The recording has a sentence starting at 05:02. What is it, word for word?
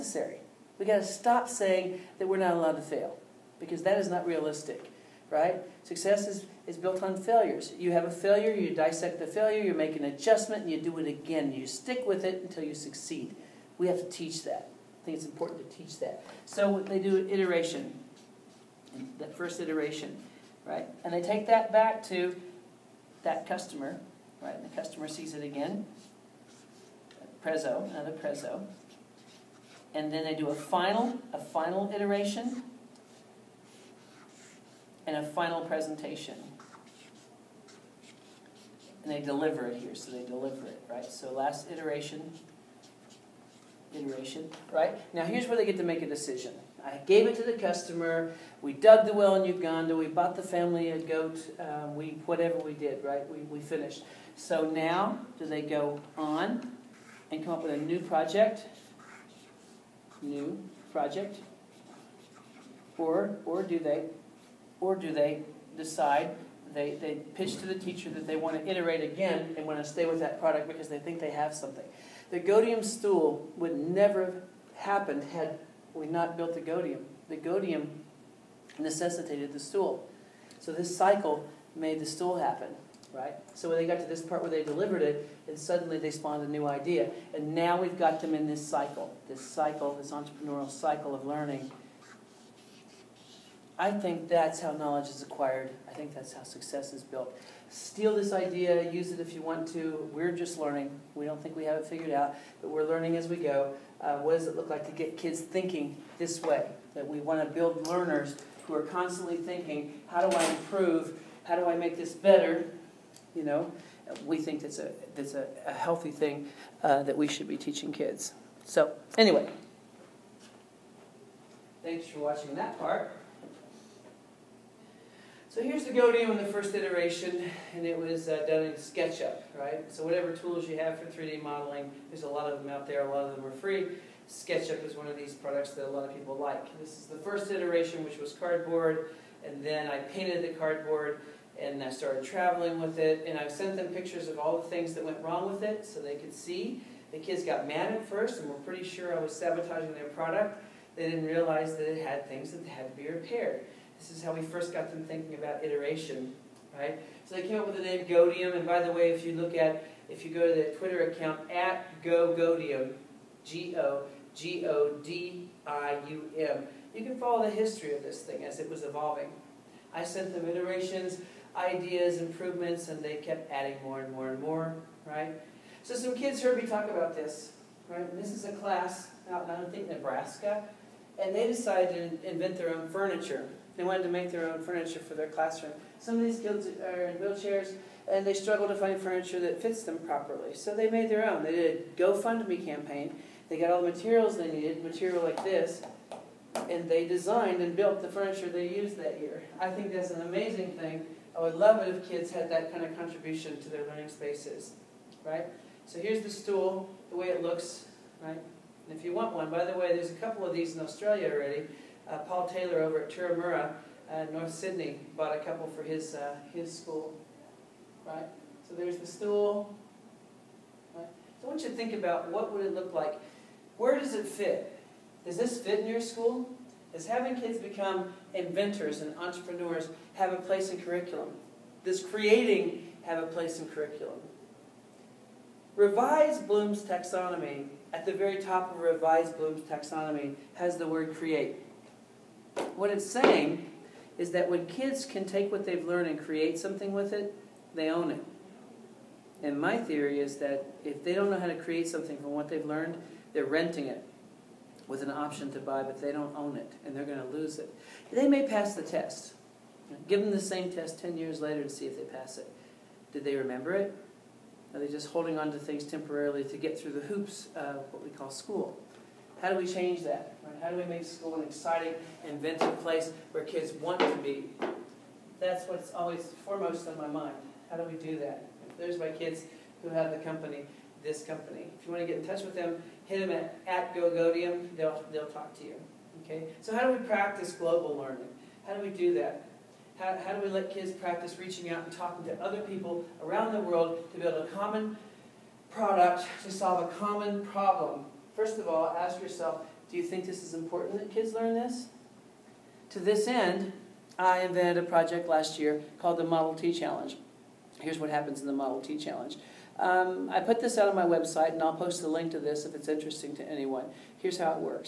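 To this end, I invented a project last year called the Model T Challenge.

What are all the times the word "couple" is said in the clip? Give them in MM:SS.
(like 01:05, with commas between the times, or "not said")
03:30, 03:35.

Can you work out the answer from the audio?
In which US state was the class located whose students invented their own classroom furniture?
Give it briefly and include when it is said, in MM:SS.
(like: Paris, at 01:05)
Nebraska, at 02:59.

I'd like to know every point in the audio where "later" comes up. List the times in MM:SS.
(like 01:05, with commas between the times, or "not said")
04:21.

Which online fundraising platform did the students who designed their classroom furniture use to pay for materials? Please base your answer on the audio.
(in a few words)
GoFundMe.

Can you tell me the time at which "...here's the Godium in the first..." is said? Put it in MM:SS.
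02:05.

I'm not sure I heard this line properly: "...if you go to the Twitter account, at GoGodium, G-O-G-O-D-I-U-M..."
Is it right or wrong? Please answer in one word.
right.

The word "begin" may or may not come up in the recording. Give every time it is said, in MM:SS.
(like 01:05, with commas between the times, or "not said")
not said.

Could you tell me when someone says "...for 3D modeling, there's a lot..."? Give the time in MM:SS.
02:10.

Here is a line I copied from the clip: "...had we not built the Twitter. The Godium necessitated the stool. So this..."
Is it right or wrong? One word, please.
wrong.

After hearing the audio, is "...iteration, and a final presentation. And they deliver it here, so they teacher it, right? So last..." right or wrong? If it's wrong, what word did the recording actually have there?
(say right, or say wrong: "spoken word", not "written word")
wrong: "deliver", not "teacher".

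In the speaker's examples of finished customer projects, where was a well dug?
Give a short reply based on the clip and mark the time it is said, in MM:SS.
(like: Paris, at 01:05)
Uganda, at 00:49.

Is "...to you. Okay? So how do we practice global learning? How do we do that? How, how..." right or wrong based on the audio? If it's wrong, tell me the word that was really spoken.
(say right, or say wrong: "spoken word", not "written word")
right.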